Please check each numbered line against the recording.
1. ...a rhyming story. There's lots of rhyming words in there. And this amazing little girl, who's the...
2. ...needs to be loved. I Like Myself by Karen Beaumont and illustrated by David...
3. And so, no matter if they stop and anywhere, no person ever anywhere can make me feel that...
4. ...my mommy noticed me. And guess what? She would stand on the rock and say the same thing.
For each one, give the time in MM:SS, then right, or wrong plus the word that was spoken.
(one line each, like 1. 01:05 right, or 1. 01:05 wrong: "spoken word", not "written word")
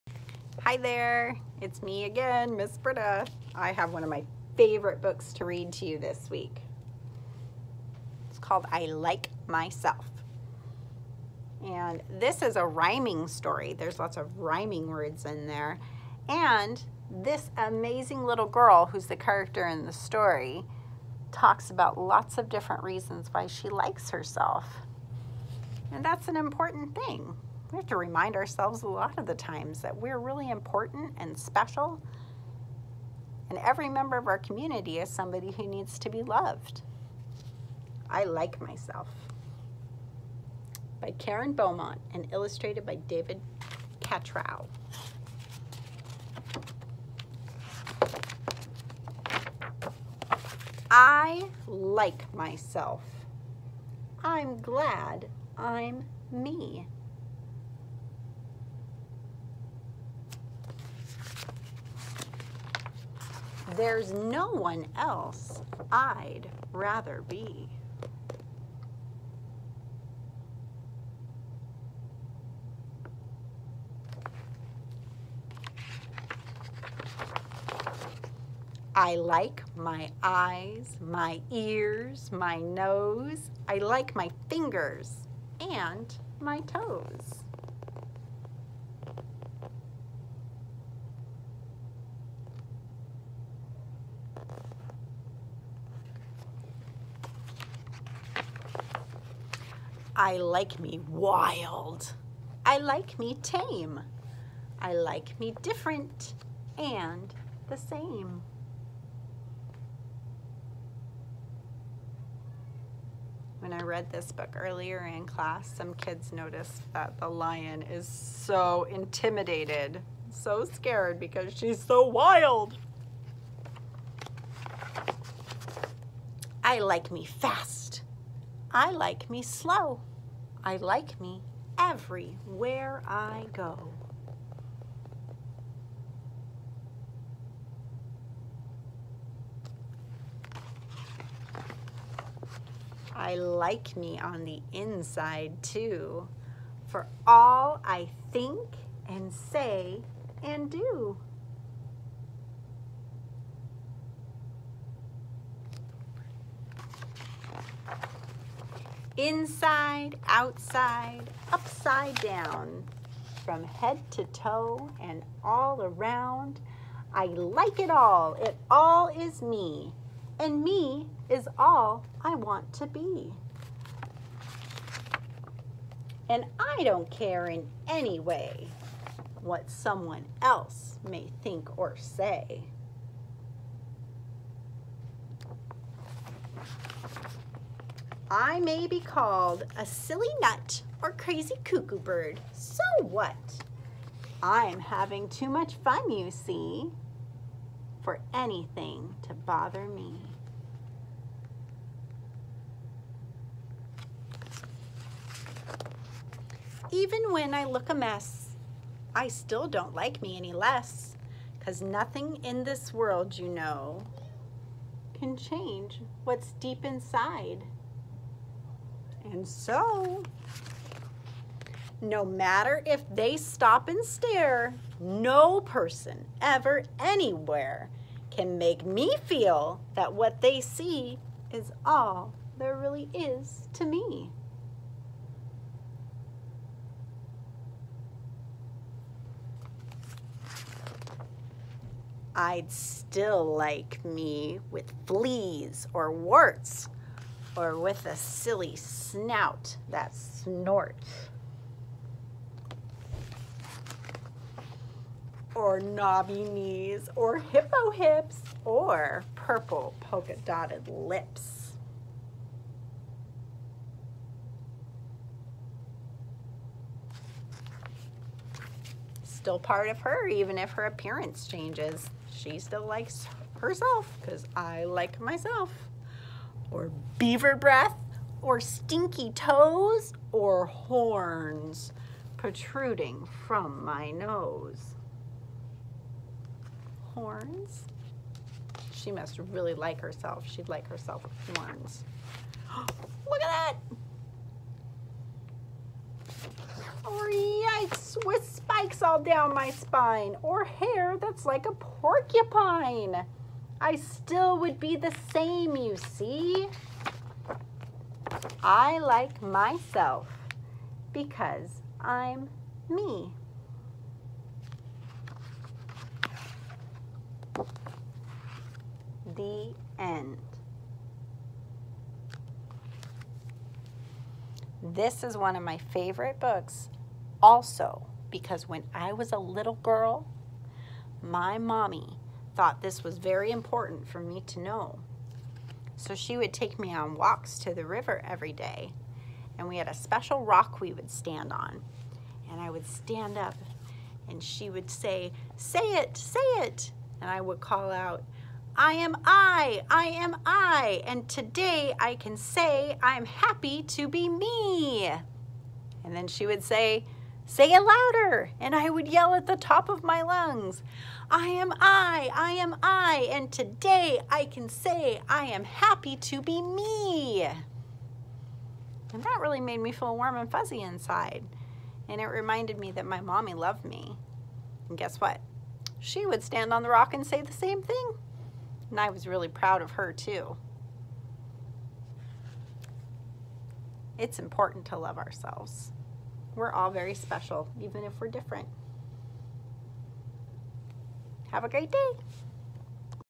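1. 00:12 right
2. 00:35 right
3. 03:39 wrong: "stare", not "anywhere"
4. 06:13 wrong: "loved", not "noticed".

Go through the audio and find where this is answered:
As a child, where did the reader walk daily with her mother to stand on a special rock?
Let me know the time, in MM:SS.
05:37.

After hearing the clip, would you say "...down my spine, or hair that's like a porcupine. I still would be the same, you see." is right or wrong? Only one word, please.
right.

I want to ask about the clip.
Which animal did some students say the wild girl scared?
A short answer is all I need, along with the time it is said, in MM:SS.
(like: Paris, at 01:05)
lion, at 01:57.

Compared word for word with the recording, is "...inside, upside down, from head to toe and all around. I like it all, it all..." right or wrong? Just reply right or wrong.
wrong.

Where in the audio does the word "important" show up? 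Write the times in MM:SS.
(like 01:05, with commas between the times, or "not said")
00:26, 00:30, 05:33, 06:24.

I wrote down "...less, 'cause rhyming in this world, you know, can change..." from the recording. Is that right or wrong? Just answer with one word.
wrong.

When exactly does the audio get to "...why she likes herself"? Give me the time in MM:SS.
00:23.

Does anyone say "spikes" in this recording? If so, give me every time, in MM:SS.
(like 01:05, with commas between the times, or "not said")
04:58.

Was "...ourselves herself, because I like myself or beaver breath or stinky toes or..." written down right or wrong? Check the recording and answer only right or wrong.
wrong.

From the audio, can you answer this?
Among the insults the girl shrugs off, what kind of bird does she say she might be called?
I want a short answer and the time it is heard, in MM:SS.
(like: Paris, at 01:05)
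cuckoo bird, at 03:11.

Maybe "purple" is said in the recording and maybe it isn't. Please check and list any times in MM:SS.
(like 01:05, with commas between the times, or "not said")
04:19.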